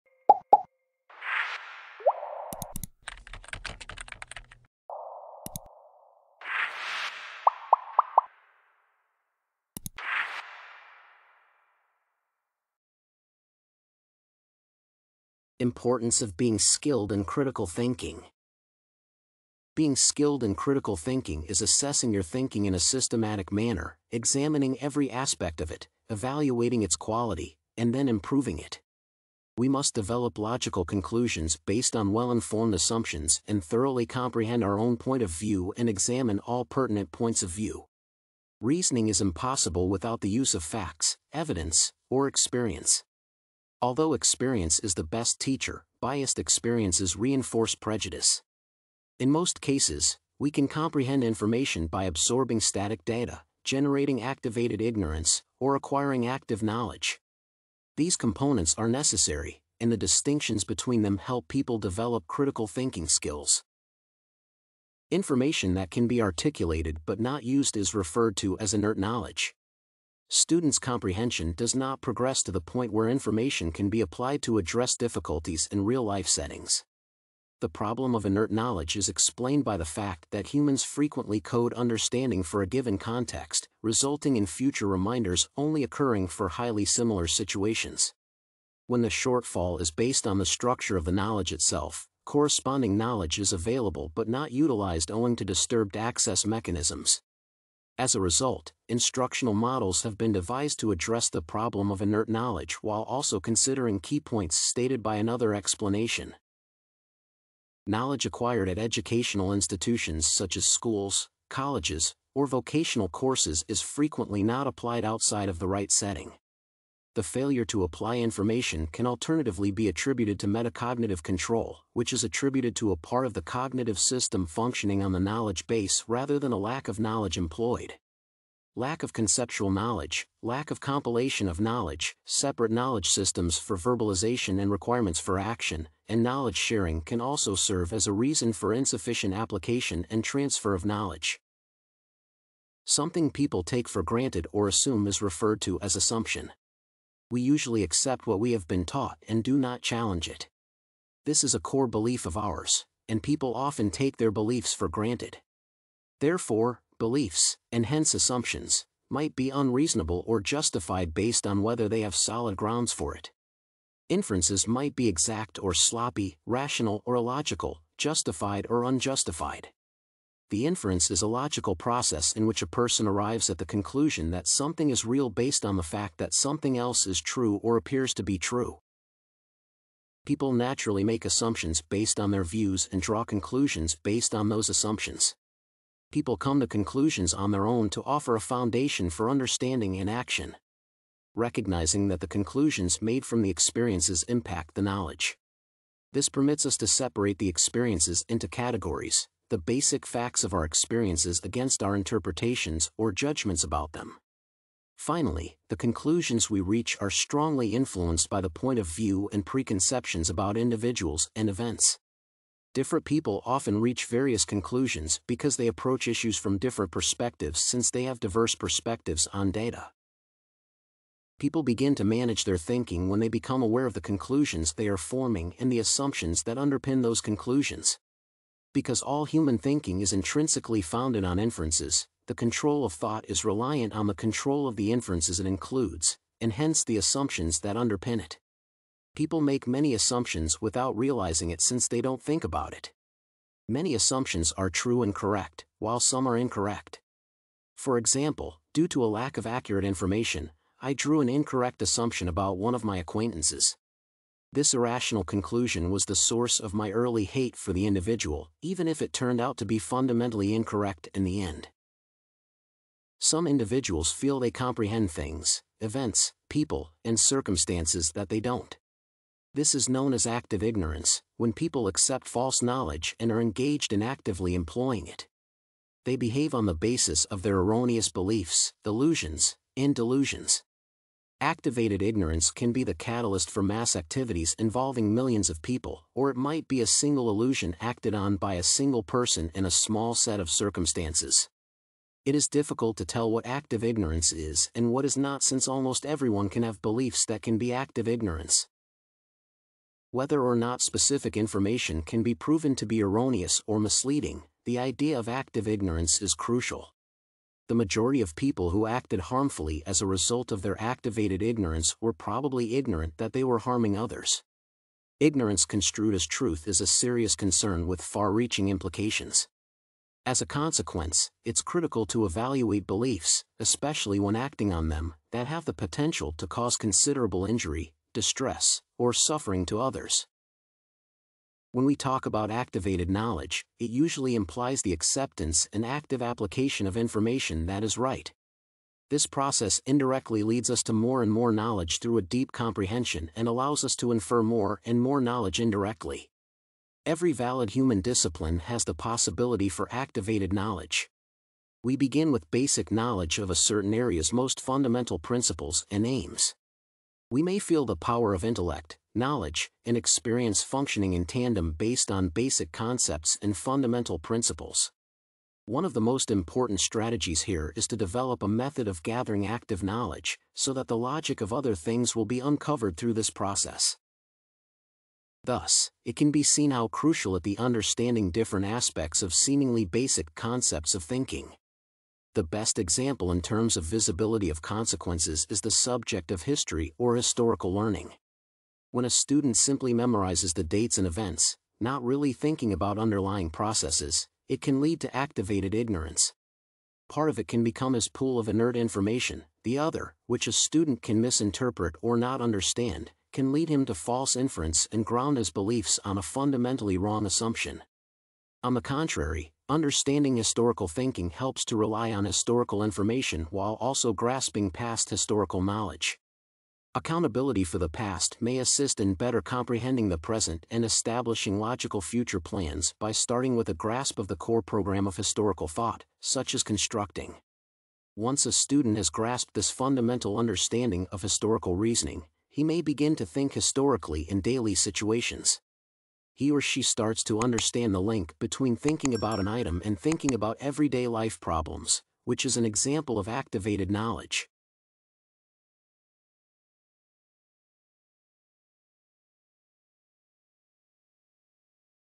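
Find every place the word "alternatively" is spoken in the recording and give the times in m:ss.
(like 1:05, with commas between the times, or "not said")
1:59.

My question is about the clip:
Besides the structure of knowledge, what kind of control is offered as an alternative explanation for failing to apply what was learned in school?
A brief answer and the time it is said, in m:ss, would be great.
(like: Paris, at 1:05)
Metacognitive control, at 2:00.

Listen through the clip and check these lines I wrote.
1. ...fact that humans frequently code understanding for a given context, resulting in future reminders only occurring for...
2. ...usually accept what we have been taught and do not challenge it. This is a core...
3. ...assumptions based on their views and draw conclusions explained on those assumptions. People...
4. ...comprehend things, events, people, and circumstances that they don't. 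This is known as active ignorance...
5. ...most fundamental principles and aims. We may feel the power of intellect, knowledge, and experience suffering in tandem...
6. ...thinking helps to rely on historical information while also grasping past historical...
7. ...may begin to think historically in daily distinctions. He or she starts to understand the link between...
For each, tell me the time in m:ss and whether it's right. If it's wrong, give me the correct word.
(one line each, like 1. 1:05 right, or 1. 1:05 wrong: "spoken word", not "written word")
1. 1:19 right
2. 2:27 right
3. 3:01 wrong: "based", not "explained"
4. 4:24 right
5. 5:54 wrong: "functioning", not "suffering"
6. 6:50 right
7. 7:12 wrong: "situations", not "distinctions".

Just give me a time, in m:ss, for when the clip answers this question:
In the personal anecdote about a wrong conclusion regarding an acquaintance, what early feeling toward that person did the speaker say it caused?
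4:17.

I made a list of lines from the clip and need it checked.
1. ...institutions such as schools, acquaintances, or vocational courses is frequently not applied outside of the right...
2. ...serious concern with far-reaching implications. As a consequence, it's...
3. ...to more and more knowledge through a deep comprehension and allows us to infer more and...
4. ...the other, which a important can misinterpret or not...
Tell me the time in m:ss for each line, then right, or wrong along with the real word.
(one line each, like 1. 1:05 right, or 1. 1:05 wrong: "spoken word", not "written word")
1. 1:49 wrong: "colleges", not "acquaintances"
2. 5:16 right
3. 5:40 right
4. 6:39 wrong: "student", not "important".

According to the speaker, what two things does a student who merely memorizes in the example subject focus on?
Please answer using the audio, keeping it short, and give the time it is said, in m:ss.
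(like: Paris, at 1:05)
Dates and events, at 6:30.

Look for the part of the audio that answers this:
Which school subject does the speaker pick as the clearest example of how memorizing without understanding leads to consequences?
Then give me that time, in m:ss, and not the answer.
6:26.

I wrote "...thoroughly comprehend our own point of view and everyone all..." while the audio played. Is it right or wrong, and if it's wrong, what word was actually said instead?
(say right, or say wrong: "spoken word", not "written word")
wrong: "examine", not "everyone".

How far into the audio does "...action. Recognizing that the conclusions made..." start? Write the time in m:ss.
3:10.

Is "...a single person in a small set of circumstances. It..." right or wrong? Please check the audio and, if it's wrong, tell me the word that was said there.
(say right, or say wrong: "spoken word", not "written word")
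right.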